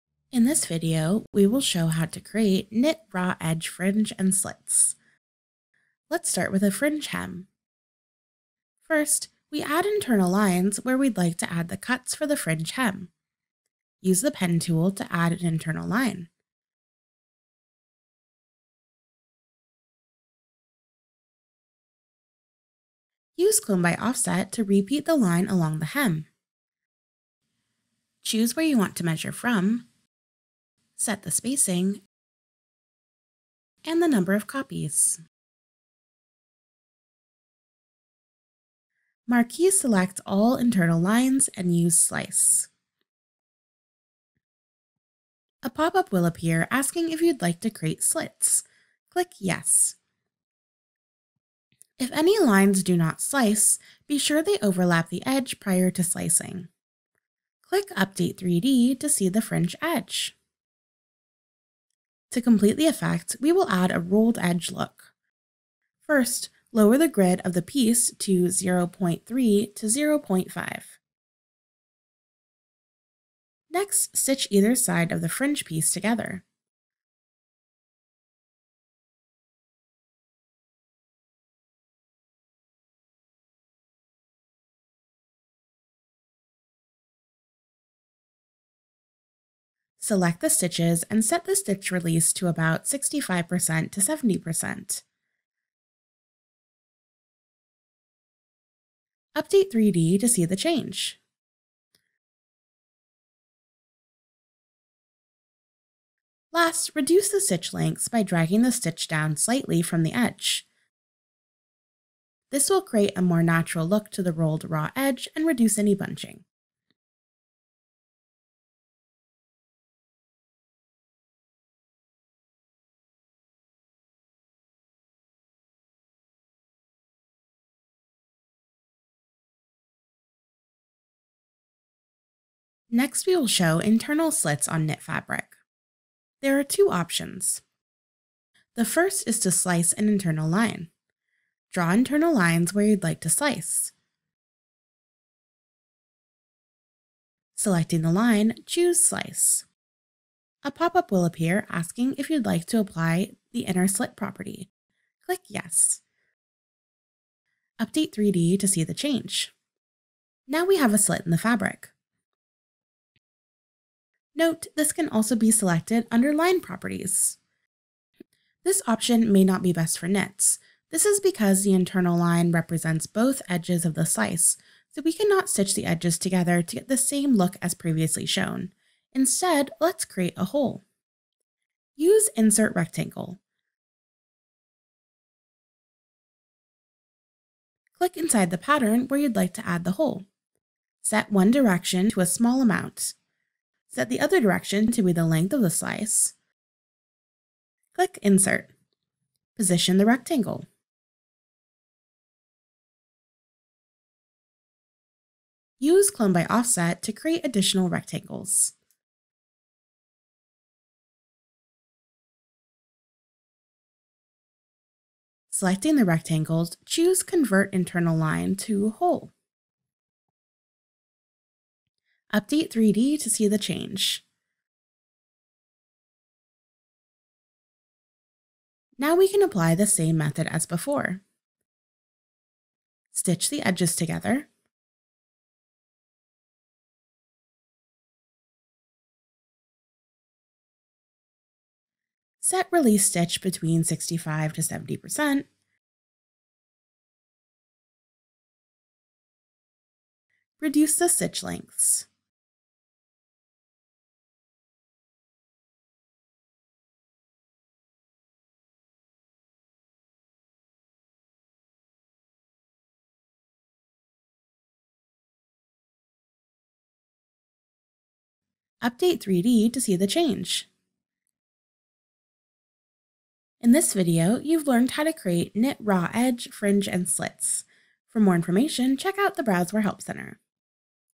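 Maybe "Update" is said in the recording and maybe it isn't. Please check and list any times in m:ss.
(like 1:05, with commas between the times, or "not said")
0:57, 1:39, 2:37, 3:42, 4:28.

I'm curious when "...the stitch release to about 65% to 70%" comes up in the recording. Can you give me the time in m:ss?
1:31.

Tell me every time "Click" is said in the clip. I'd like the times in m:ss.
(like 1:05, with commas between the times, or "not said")
0:49, 0:57, 2:35, 3:07, 3:17.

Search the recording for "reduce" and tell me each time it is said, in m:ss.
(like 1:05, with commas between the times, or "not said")
1:46, 1:55, 4:10.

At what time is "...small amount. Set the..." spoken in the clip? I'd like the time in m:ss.
3:12.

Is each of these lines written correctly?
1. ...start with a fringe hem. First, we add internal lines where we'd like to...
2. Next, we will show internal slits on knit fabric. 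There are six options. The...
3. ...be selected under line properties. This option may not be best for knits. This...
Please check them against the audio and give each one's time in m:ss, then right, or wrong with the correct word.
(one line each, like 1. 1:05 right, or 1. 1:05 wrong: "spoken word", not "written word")
1. 0:06 right
2. 2:12 wrong: "two", not "six"
3. 2:45 right.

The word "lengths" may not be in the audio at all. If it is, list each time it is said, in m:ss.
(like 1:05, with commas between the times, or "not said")
1:47, 3:15, 4:11.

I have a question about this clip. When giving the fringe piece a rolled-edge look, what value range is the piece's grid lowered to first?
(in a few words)
0.3 to 0.5.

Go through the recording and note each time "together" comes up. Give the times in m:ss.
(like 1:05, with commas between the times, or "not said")
1:15, 2:56, 3:53.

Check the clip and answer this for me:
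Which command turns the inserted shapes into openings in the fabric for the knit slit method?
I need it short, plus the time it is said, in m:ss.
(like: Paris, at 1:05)
Convert Internal Line to Hole, at 3:37.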